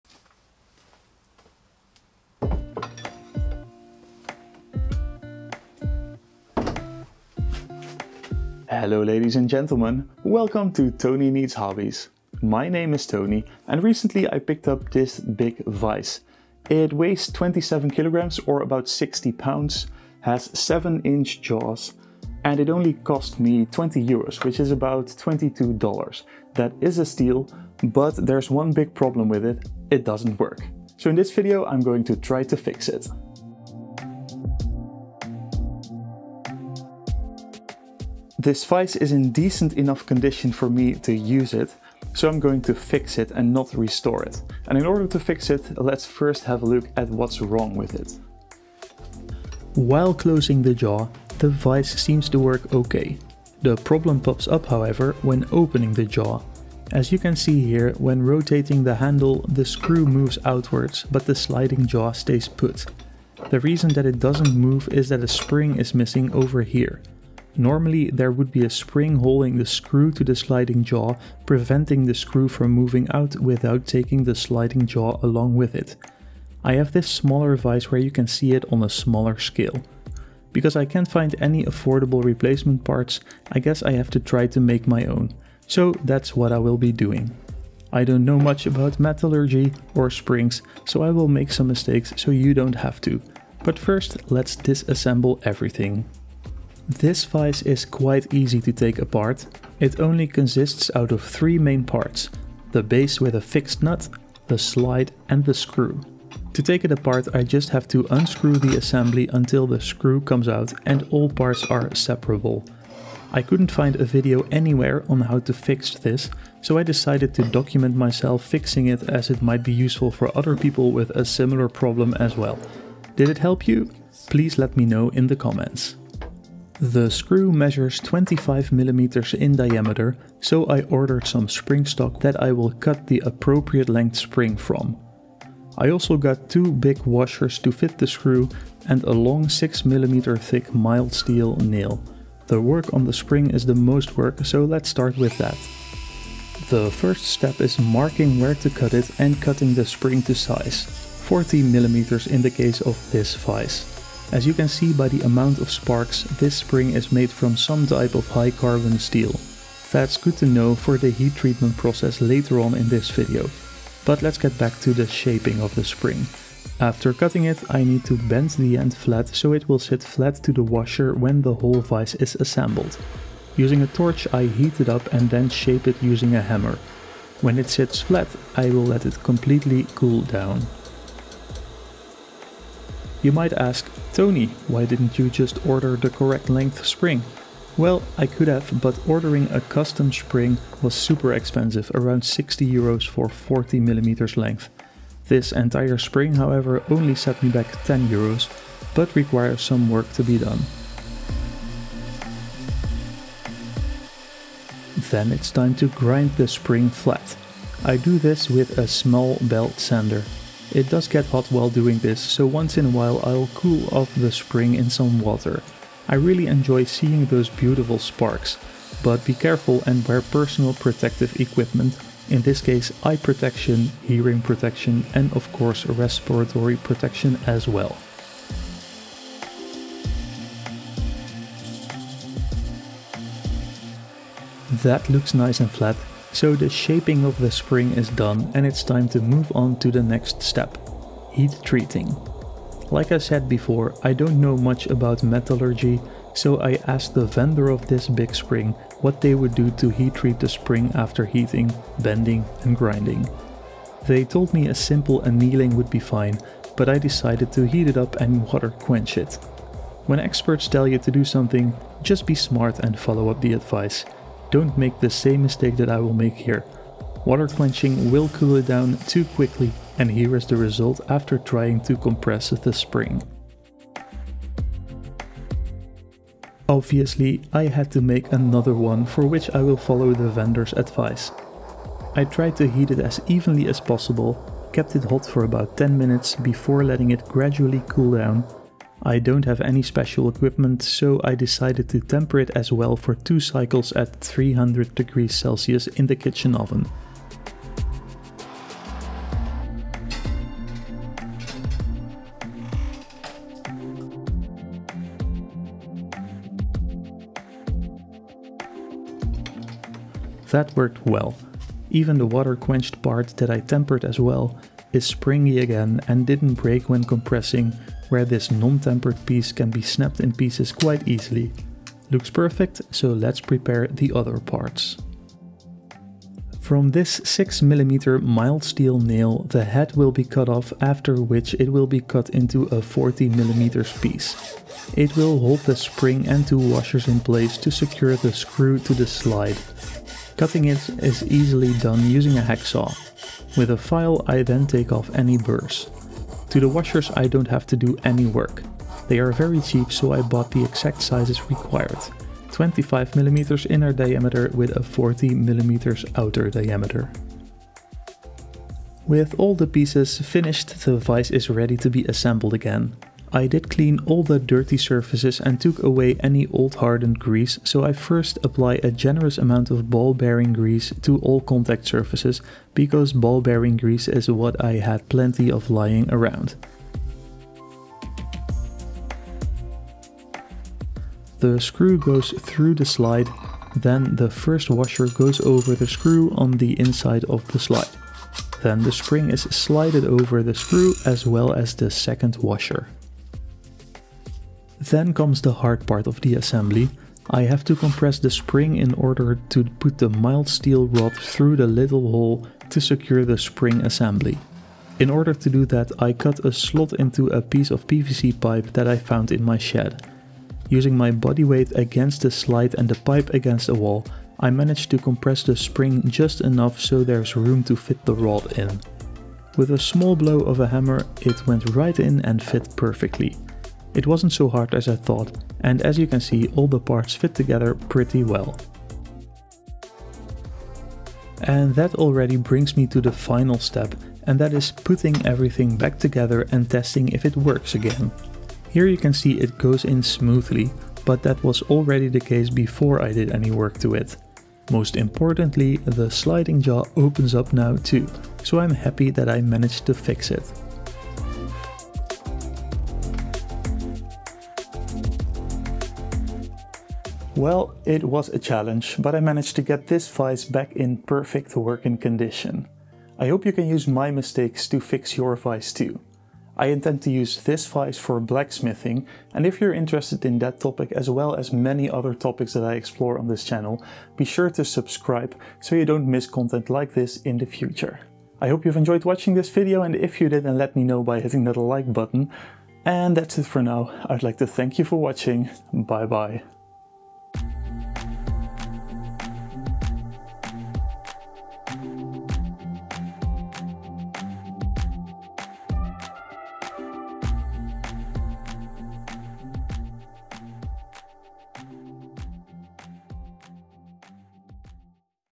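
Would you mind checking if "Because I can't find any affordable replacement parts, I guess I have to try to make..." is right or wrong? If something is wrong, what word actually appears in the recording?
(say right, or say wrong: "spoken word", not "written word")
right.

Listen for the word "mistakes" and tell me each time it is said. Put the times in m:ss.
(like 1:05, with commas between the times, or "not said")
1:31, 4:25, 7:44.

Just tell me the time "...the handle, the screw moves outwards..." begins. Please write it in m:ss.
0:58.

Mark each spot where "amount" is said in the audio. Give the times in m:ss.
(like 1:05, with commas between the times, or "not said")
2:35, 6:09.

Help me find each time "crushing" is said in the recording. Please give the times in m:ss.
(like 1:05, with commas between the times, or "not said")
not said.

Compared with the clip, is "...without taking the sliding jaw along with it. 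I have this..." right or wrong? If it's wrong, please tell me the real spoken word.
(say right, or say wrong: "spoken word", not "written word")
right.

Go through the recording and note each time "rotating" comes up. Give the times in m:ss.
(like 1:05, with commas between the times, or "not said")
0:58.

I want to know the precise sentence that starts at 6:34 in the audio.
Then comes the hard part of the assembly.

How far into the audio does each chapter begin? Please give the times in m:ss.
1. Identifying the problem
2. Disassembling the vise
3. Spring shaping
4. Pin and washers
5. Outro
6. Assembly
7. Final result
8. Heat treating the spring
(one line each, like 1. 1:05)
1. 0:48
2. 1:35
3. 2:06
4. 5:25
5. 7:35
6. 5:59
7. 7:07
8. 3:57.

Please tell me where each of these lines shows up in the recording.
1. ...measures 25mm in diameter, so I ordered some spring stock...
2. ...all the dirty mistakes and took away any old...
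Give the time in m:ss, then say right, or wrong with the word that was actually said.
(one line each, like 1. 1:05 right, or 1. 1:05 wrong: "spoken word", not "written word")
1. 2:07 right
2. 6:04 wrong: "surfaces", not "mistakes".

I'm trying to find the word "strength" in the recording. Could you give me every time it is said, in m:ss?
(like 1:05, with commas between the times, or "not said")
not said.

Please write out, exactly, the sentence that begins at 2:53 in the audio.
Using a torch I heat it up and then shape it using a hammer.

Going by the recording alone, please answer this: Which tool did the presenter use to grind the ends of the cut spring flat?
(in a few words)
belt sander.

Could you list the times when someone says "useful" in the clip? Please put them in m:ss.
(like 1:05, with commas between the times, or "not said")
1:59.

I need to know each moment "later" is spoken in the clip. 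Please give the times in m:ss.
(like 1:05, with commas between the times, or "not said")
2:42.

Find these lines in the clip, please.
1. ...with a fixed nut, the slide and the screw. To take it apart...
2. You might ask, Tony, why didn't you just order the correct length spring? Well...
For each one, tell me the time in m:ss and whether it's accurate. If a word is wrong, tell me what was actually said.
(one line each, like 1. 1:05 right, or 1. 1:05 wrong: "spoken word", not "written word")
1. 1:43 right
2. 3:03 right.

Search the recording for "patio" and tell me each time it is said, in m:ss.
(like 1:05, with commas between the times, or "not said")
not said.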